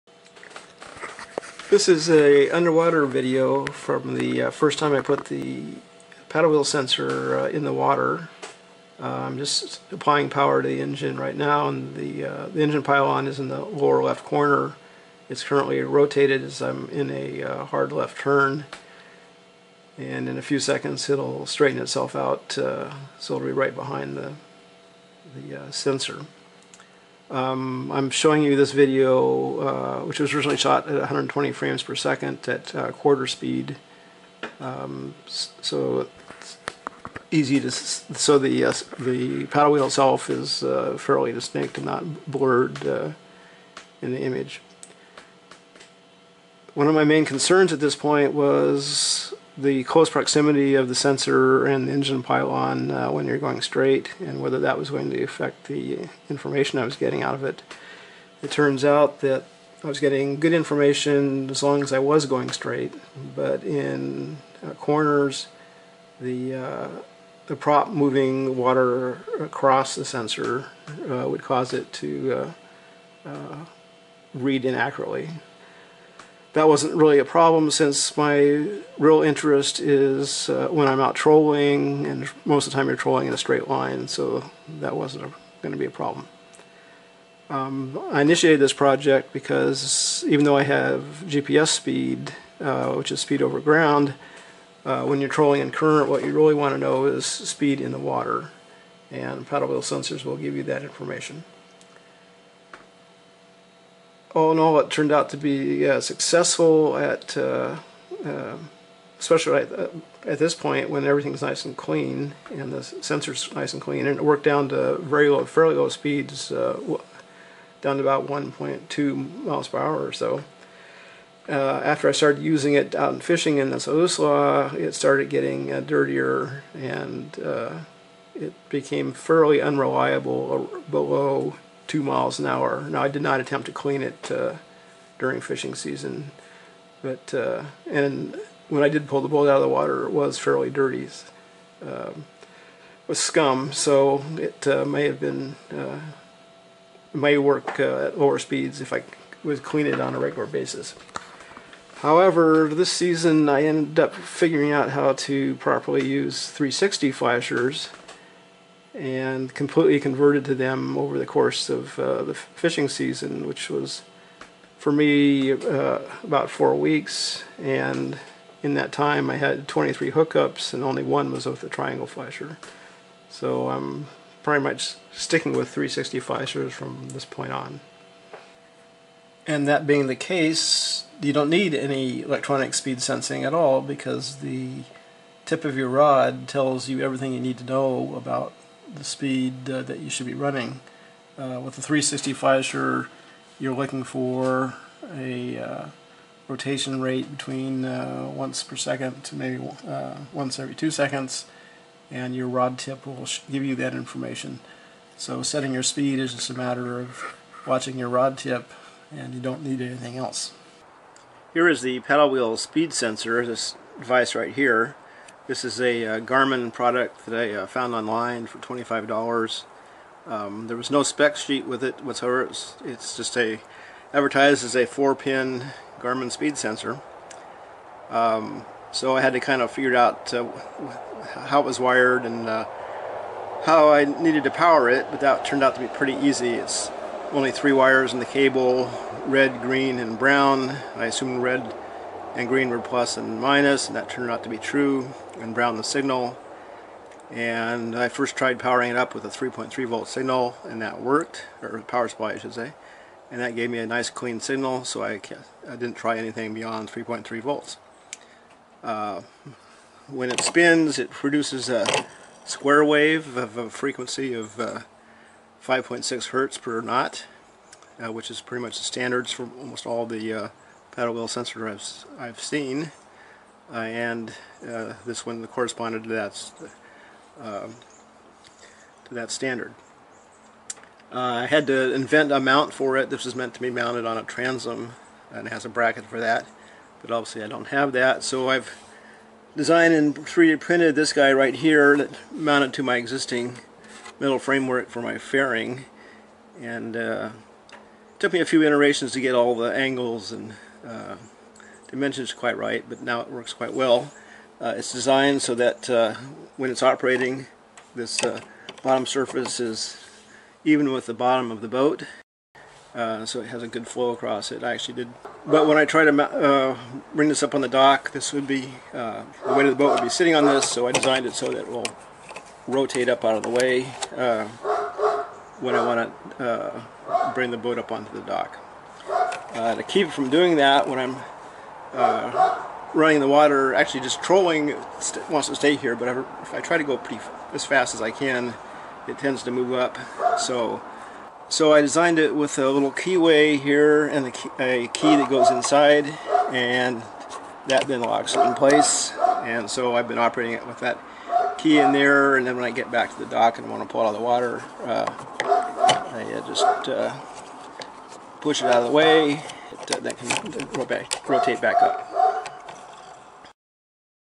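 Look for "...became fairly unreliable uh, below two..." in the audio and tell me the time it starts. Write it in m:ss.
2:08.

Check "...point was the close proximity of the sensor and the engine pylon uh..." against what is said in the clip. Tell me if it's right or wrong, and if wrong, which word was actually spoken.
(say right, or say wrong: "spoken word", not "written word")
right.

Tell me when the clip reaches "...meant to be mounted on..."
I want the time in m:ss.
4:43.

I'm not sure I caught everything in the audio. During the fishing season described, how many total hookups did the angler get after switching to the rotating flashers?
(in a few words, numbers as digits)
23.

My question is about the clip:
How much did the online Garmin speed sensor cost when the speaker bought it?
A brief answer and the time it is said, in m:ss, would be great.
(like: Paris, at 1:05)
$25, at 3:38.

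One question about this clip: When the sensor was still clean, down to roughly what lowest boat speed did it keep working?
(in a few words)
1.2 miles per hour.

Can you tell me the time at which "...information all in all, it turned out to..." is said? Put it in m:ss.
1:40.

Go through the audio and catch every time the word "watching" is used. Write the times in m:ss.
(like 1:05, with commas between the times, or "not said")
3:27.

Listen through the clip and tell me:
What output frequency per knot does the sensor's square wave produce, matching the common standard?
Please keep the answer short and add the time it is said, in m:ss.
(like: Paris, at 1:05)
5.6 hertz per knot, at 4:25.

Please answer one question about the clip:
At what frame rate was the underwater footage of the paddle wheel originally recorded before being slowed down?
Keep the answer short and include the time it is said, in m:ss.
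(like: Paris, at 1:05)
120 frames per second, at 0:30.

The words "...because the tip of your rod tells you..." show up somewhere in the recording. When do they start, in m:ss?
3:03.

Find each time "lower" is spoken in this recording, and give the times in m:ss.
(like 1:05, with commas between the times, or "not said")
0:13, 2:28.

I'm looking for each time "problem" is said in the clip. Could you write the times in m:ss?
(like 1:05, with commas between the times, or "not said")
1:17, 1:25.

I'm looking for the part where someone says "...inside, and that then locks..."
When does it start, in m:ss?
5:45.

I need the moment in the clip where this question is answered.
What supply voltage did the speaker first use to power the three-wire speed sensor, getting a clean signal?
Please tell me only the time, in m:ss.
4:09.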